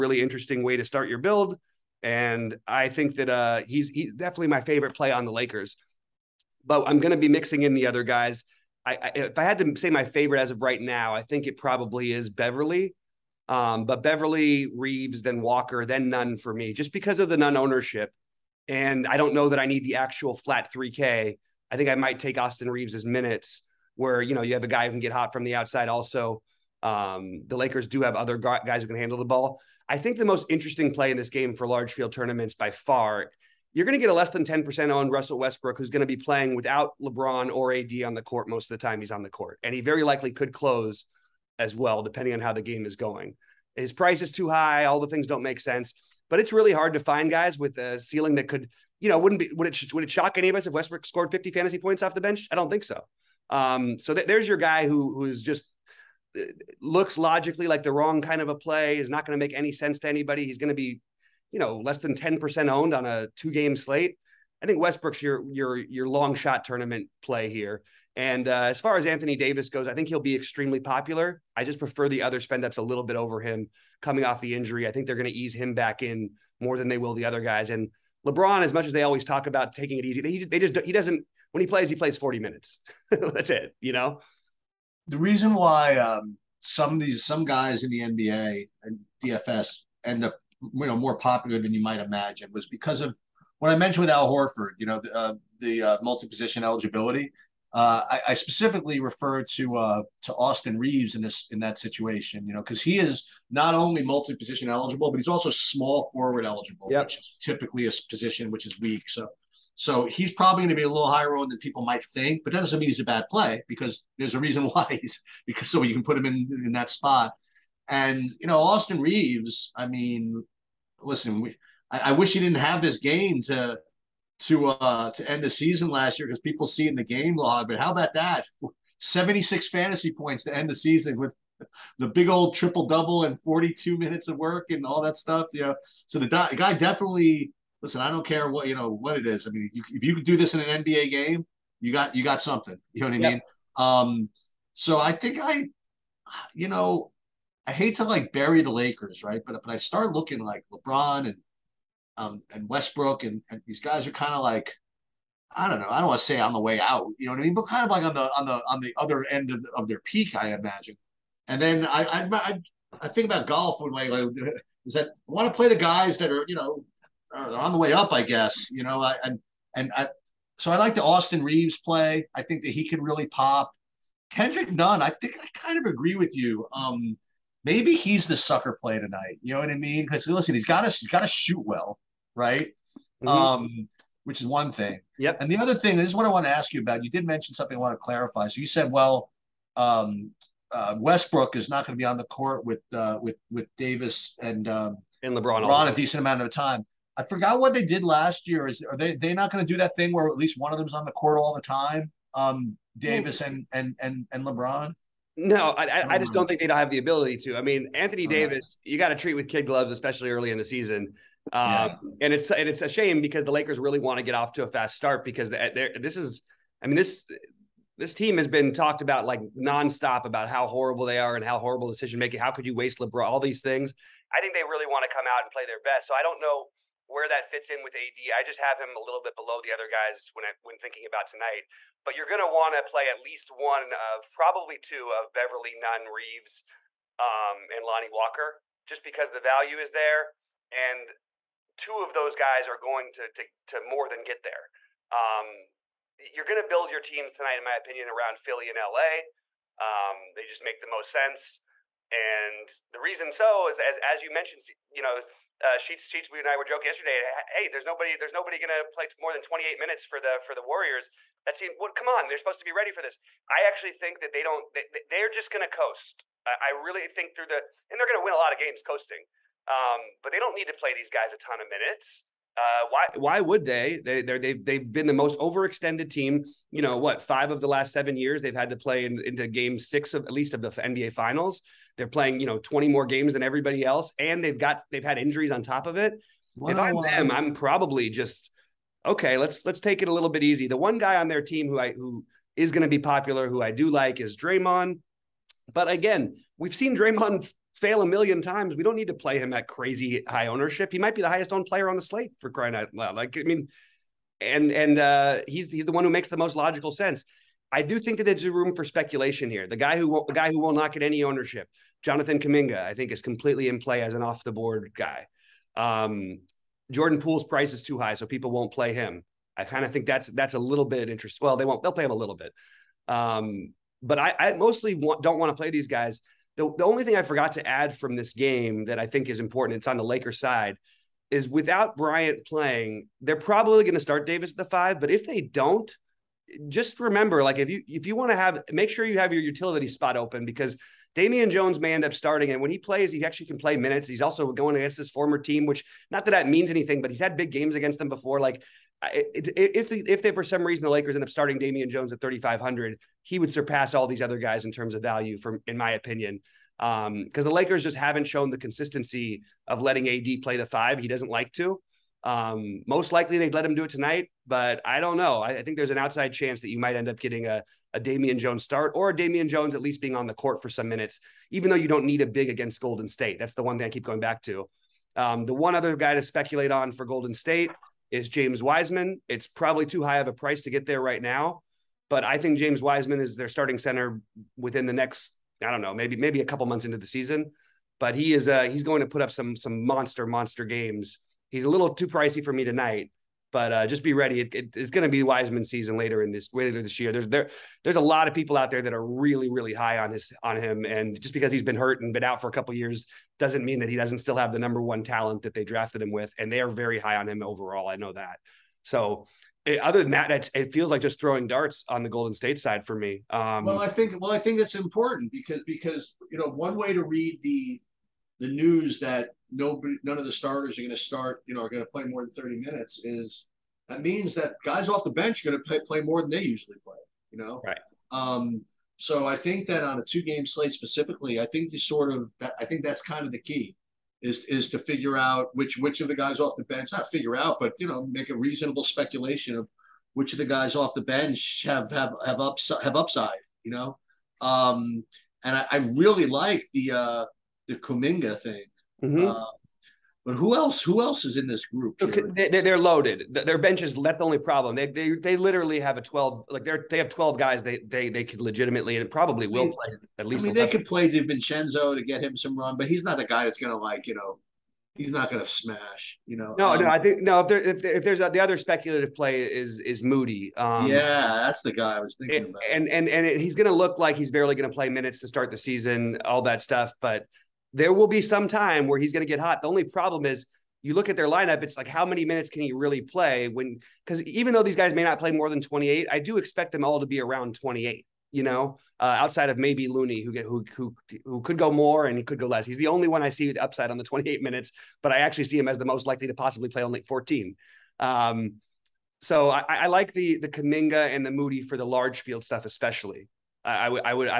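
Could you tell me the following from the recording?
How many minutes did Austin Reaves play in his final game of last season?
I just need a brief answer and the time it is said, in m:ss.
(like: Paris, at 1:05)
42, at 2:13.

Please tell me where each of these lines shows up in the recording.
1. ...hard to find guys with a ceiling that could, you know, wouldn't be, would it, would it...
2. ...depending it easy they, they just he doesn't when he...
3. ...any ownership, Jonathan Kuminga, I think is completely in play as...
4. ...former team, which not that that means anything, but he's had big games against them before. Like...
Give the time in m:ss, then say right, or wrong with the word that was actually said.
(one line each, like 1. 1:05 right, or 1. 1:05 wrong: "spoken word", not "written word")
1. 0:46 right
2. 1:19 wrong: "taking", not "depending"
3. 5:11 right
4. 5:45 right.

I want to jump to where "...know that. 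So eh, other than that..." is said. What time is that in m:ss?
6:47.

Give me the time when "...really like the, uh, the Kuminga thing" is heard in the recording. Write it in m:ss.
7:25.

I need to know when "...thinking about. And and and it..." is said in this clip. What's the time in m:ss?
7:52.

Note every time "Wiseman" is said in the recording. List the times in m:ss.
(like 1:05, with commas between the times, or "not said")
6:18, 6:22, 6:35.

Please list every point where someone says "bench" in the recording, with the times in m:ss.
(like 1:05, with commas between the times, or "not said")
0:52, 7:05, 7:16, 7:21, 7:33.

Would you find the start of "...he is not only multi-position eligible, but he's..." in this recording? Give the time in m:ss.
1:42.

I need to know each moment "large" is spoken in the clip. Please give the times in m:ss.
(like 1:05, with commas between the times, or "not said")
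0:31, 8:21.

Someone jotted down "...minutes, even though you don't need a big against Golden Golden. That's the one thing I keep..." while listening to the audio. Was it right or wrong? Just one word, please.
wrong.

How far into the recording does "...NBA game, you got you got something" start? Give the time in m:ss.
2:20.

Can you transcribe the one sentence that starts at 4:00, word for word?
And two of those guys are going to, to, to more than get there.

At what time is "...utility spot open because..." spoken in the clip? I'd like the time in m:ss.
5:39.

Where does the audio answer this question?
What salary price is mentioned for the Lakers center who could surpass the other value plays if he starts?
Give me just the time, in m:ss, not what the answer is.
5:52.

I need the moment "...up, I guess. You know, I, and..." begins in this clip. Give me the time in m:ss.
2:47.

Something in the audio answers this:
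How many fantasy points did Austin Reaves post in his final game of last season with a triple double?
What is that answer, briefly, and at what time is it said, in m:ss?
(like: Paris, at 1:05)
76, at 2:08.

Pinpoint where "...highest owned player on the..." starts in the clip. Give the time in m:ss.
5:01.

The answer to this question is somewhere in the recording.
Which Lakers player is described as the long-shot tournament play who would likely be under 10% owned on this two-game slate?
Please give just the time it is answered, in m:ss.
0:35.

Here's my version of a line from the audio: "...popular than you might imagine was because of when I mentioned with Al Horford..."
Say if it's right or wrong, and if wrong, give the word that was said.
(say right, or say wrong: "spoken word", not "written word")
right.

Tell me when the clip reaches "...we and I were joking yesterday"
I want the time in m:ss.
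4:16.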